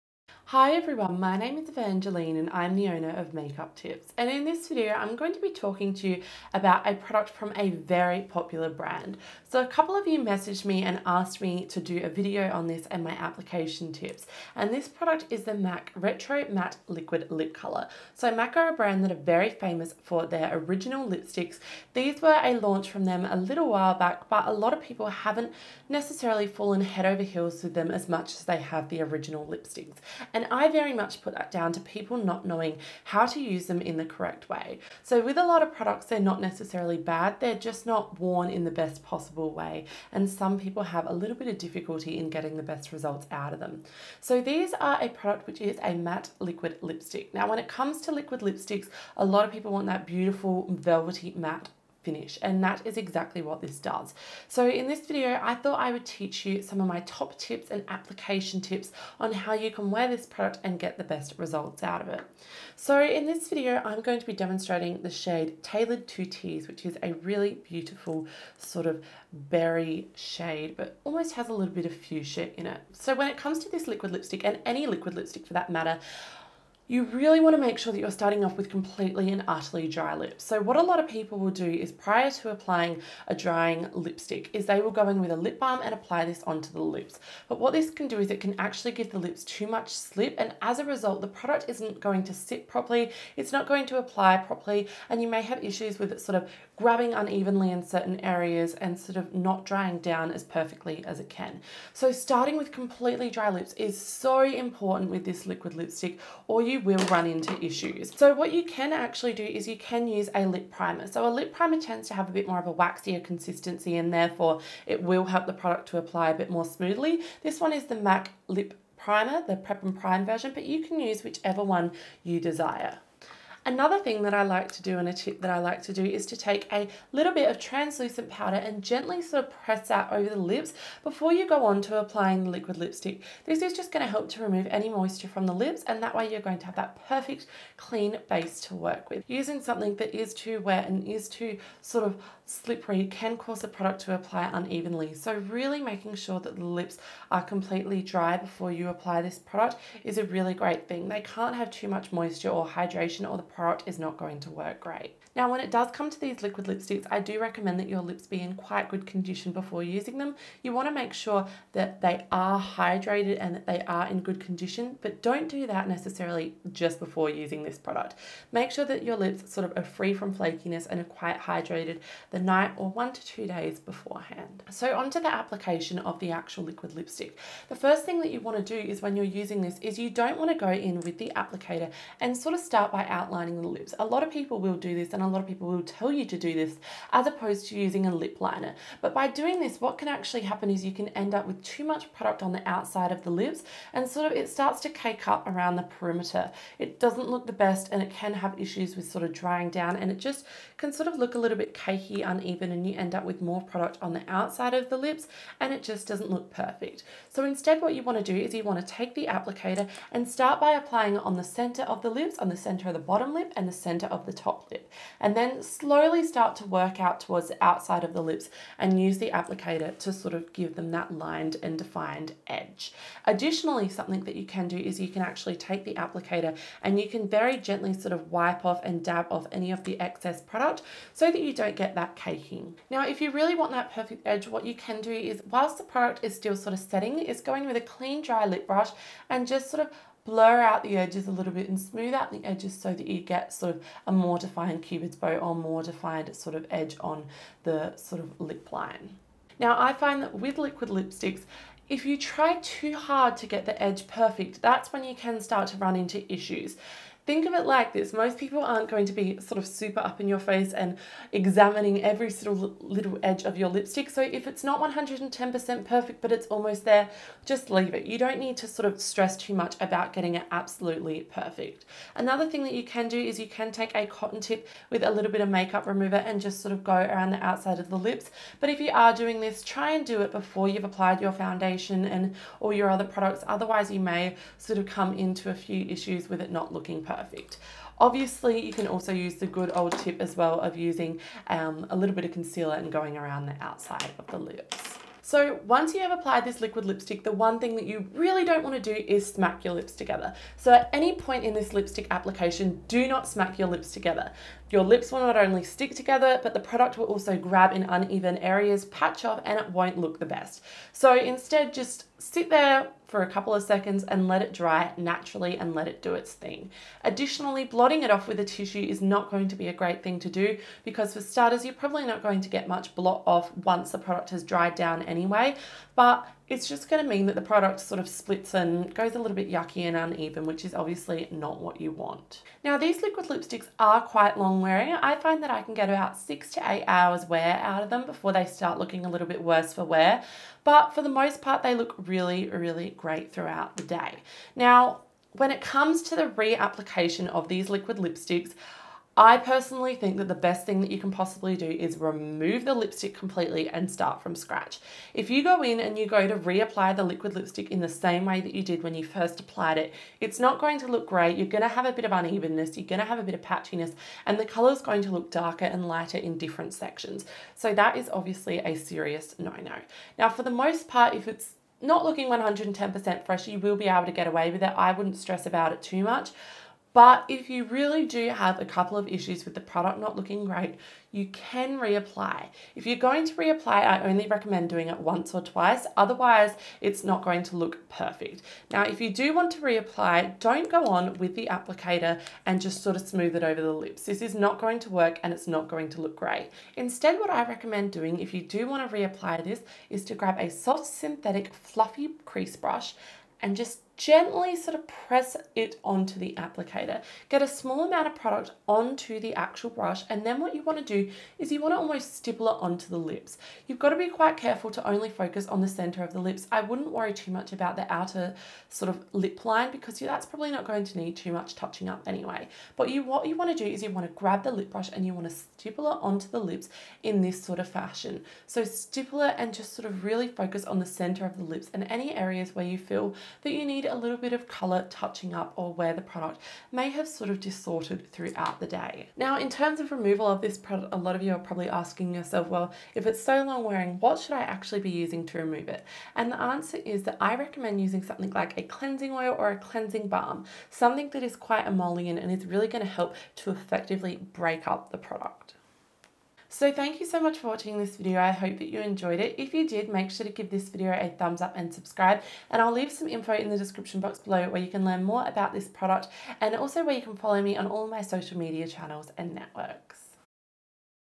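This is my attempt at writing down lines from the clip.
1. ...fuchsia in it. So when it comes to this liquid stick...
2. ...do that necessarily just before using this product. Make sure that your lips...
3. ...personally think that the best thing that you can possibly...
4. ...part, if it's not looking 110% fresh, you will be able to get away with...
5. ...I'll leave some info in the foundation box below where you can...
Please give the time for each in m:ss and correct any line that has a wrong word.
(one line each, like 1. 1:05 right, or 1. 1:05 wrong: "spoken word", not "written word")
1. 1:11 wrong: "lipstick", not "stick"
2. 2:45 right
3. 5:49 right
4. 6:10 right
5. 7:42 wrong: "description", not "foundation".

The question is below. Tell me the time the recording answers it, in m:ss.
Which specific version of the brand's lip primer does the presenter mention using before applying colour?
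1:59.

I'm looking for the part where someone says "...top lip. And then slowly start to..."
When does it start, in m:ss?
3:34.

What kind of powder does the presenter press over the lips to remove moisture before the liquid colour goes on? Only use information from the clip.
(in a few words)
Translucent powder.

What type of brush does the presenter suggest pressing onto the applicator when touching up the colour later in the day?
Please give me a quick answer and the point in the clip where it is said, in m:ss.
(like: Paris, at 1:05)
Soft synthetic fluffy crease brush, at 6:40.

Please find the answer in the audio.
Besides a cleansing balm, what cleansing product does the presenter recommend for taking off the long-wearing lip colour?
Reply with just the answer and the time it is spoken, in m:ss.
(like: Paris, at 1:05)
Cleansing oil, at 7:28.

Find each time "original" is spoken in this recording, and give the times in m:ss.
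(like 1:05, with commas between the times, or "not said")
0:20, 0:29.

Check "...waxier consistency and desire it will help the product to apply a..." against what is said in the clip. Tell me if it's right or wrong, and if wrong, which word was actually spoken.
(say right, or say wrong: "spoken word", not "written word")
wrong: "therefore", not "desire".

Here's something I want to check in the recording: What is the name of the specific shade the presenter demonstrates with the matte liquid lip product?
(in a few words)
Tailored to Tease.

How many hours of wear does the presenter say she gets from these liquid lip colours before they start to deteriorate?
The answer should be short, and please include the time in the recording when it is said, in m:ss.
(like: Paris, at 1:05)
6 to 8 hours, at 5:36.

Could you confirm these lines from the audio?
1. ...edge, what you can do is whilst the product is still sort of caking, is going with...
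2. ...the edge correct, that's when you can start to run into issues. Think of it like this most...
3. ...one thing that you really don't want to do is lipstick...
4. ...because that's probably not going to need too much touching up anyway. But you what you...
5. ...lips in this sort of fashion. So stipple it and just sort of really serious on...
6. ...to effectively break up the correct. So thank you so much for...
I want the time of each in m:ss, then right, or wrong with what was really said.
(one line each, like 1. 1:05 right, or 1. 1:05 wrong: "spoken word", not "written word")
1. 3:54 wrong: "setting", not "caking"
2. 4:13 wrong: "perfect", not "correct"
3. 4:57 wrong: "smack", not "lipstick"
4. 6:59 right
5. 7:06 wrong: "focus", not "serious"
6. 7:33 wrong: "product", not "correct".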